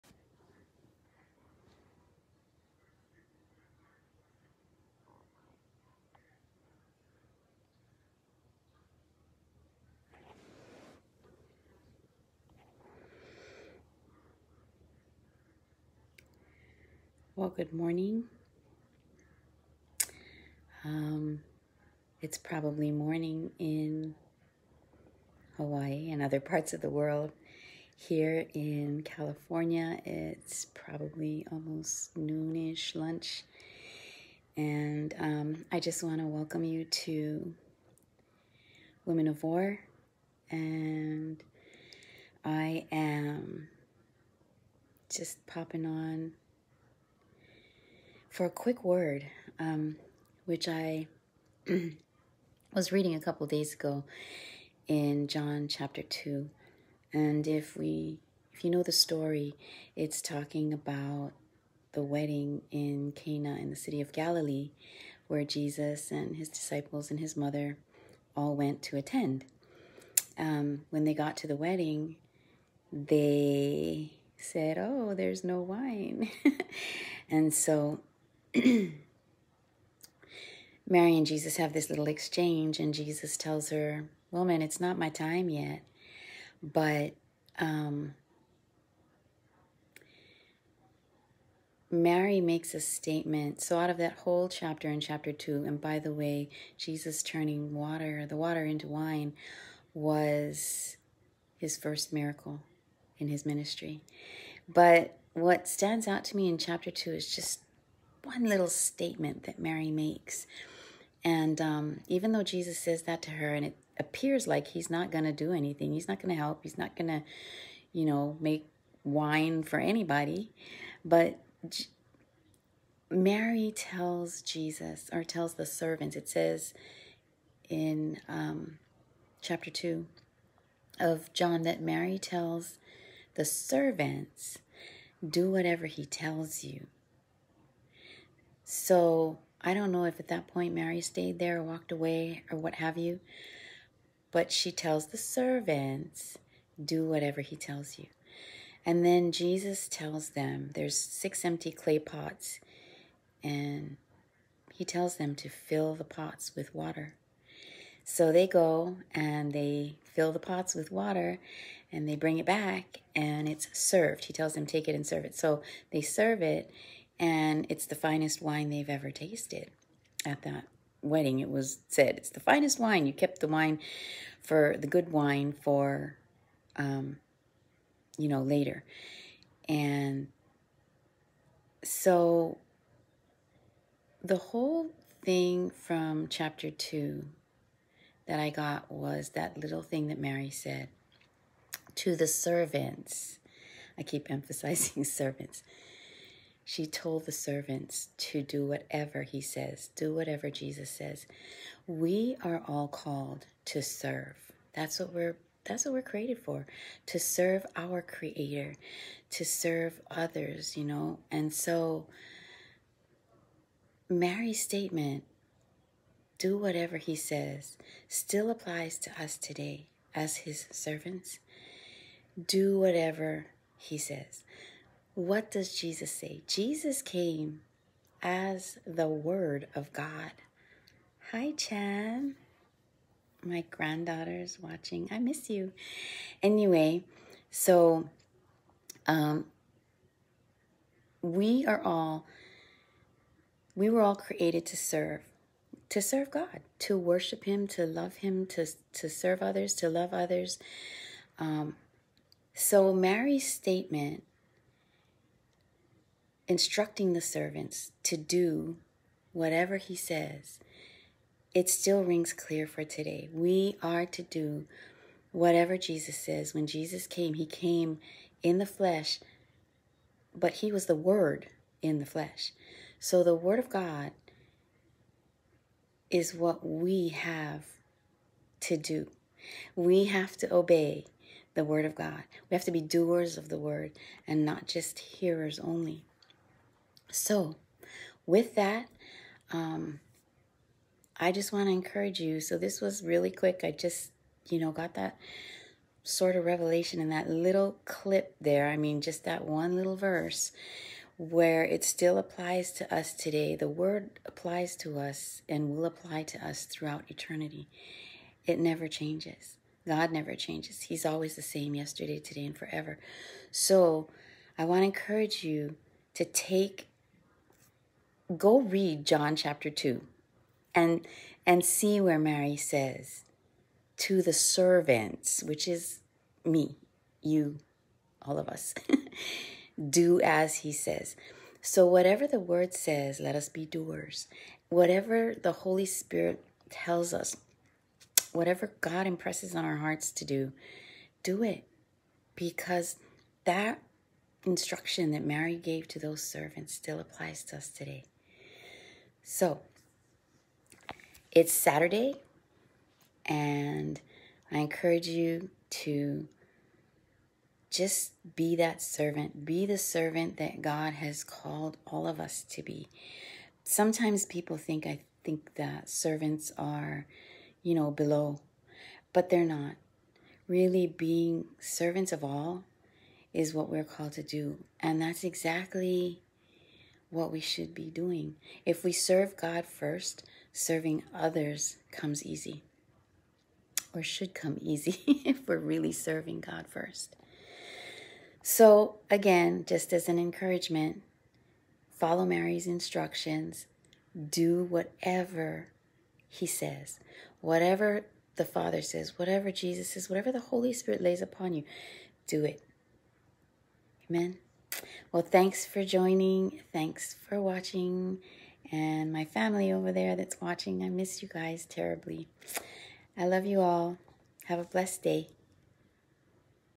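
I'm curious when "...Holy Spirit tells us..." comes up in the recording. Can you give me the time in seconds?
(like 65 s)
335 s.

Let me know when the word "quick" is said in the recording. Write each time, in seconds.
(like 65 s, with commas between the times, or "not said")
48 s, 293 s.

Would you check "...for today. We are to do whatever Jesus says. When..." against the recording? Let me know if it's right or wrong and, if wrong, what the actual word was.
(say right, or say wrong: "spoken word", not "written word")
right.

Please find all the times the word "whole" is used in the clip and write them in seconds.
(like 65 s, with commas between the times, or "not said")
94 s, 184 s.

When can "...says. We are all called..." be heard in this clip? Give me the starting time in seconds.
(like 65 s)
200 s.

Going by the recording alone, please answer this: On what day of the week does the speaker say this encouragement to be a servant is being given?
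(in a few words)
Saturday.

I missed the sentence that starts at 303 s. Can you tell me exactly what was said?
The word applies to us and will apply to us throughout eternity.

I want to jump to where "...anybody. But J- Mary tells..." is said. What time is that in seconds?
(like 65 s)
119 s.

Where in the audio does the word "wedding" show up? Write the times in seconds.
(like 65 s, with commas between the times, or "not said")
62 s, 71 s, 171 s.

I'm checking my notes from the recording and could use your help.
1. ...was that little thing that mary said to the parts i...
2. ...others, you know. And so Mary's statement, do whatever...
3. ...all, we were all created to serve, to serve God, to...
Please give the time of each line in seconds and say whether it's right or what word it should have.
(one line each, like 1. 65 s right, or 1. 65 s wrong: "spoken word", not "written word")
1. 188 s wrong: "servants", not "parts"
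2. 210 s right
3. 241 s right.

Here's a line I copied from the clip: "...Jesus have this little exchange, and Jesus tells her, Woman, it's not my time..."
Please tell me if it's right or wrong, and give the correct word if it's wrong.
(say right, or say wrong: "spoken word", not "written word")
right.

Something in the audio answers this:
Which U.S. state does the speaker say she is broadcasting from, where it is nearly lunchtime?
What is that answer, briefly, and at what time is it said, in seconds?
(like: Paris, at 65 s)
California, at 29 s.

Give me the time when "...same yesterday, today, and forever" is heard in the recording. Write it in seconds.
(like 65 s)
311 s.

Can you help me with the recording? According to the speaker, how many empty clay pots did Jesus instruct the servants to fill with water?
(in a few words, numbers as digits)
6.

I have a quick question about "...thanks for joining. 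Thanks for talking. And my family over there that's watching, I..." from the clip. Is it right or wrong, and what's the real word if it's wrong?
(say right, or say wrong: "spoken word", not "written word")
wrong: "watching", not "talking".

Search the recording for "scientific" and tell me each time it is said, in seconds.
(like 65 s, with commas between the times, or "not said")
not said.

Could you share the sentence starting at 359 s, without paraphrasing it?
Be the servant that God has called all of us to be.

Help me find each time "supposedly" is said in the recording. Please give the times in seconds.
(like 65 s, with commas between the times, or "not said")
not said.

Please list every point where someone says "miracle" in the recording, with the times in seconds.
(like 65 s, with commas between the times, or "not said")
102 s.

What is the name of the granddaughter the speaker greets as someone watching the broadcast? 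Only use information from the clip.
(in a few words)
Chan.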